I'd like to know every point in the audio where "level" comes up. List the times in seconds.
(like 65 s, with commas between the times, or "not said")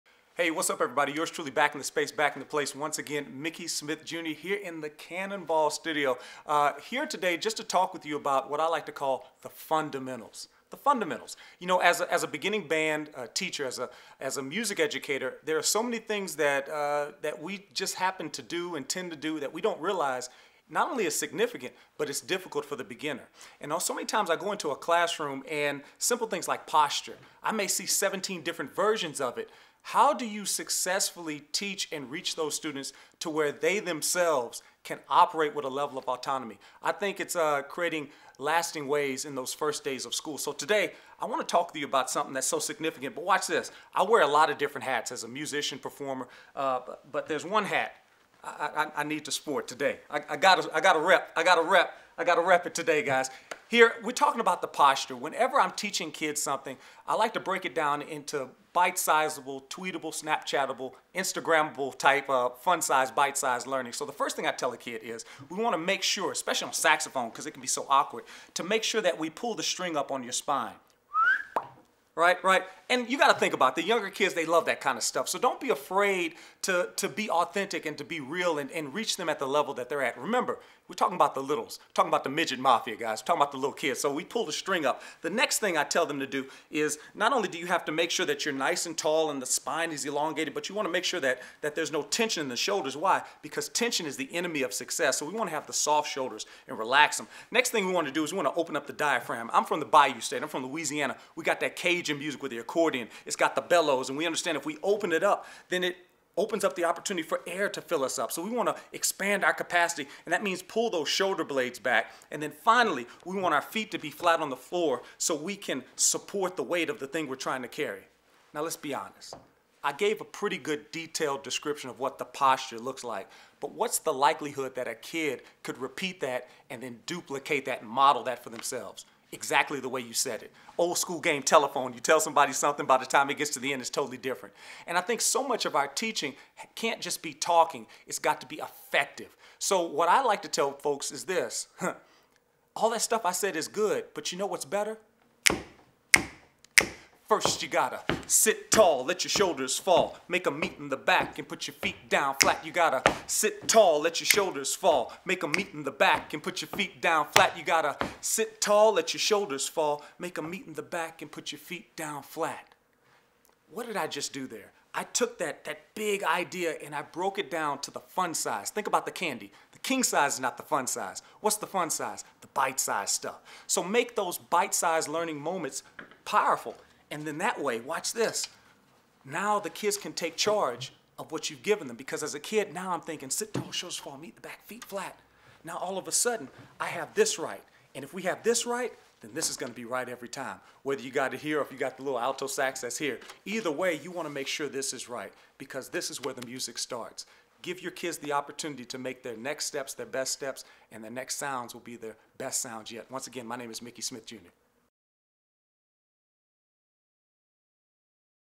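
35 s, 79 s.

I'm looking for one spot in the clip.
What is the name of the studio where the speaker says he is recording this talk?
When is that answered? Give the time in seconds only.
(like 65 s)
4 s.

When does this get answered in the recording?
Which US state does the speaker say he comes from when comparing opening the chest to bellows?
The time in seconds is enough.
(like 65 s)
100 s.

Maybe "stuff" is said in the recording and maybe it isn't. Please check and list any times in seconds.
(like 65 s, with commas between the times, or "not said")
75 s, 143 s, 173 s.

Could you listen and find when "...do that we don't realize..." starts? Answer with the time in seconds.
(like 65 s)
19 s.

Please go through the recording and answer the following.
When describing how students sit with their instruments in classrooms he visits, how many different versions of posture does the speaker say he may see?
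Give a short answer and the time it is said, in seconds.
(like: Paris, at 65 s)
17, at 27 s.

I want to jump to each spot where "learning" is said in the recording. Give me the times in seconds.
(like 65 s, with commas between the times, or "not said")
63 s, 175 s.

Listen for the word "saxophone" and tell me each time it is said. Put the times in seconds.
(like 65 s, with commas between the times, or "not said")
66 s.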